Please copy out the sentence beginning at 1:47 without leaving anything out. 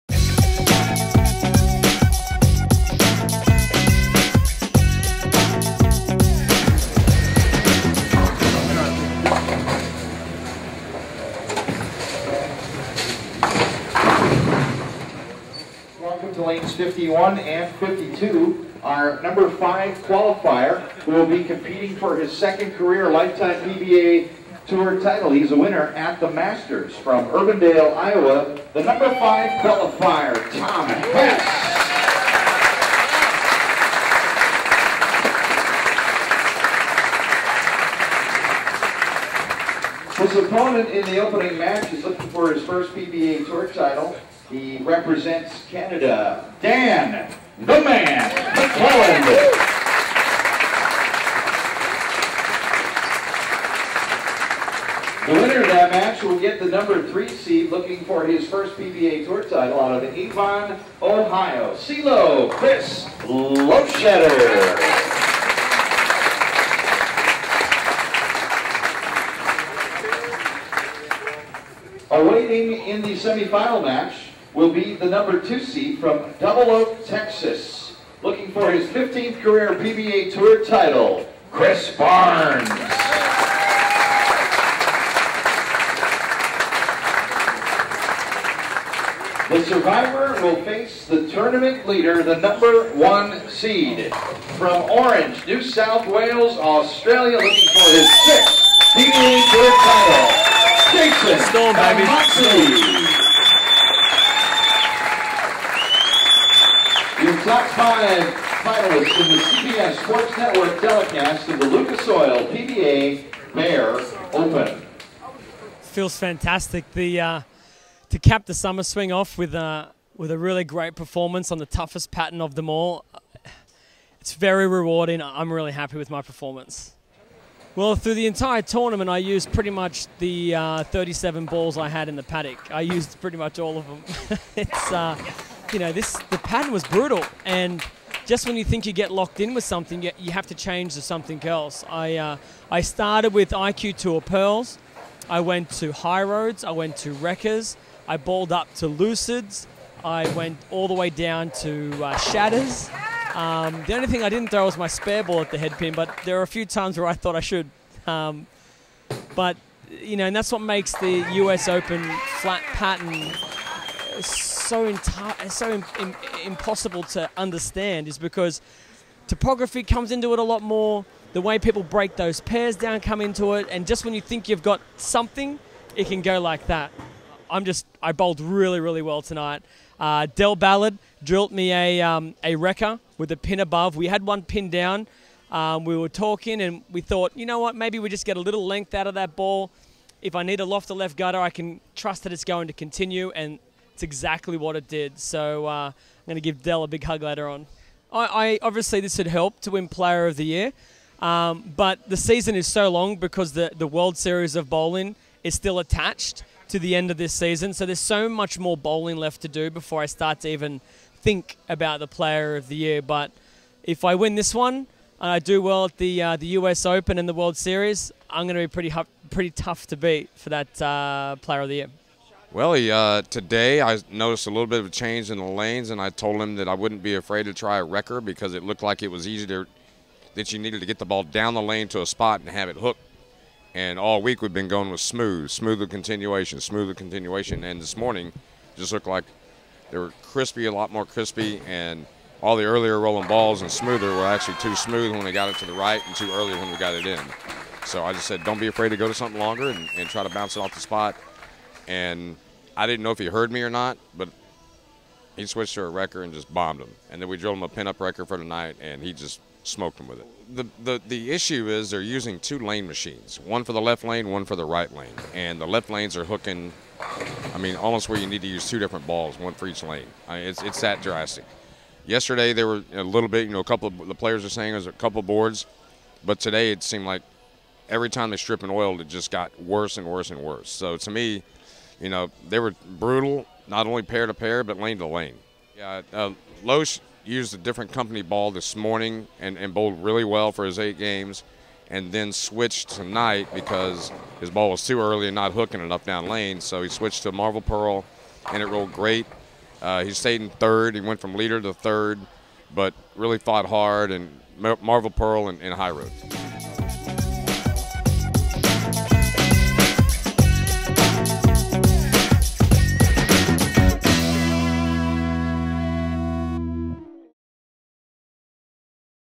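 Five finalists in the CBS Sports Network telecast of the Lucas Oil PBA Bear Open.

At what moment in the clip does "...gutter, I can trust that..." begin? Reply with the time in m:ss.
3:11.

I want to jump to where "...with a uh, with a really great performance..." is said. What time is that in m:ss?
1:59.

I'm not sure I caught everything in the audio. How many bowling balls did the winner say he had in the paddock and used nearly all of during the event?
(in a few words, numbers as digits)
37.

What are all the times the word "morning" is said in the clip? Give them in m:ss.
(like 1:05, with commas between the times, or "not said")
3:57, 4:48.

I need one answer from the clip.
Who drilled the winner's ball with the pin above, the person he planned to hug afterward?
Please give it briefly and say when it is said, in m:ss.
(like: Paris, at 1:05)
Del Ballard, at 3:00.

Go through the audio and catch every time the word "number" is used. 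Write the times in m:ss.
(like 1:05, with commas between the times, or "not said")
0:19, 0:28, 0:56, 1:15, 1:32.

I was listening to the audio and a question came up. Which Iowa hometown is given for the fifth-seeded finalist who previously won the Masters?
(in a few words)
Urbandale, Iowa.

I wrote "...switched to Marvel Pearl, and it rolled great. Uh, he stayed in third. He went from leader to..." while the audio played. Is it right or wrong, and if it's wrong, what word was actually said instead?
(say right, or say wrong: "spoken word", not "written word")
right.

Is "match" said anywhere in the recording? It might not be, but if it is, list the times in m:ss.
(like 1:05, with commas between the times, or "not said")
0:41, 0:55, 1:13.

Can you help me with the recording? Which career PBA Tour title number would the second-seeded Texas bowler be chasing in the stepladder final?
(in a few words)
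15th.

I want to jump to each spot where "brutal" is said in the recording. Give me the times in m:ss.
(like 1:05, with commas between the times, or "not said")
2:16, 4:42.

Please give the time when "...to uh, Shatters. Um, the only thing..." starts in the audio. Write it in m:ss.
2:31.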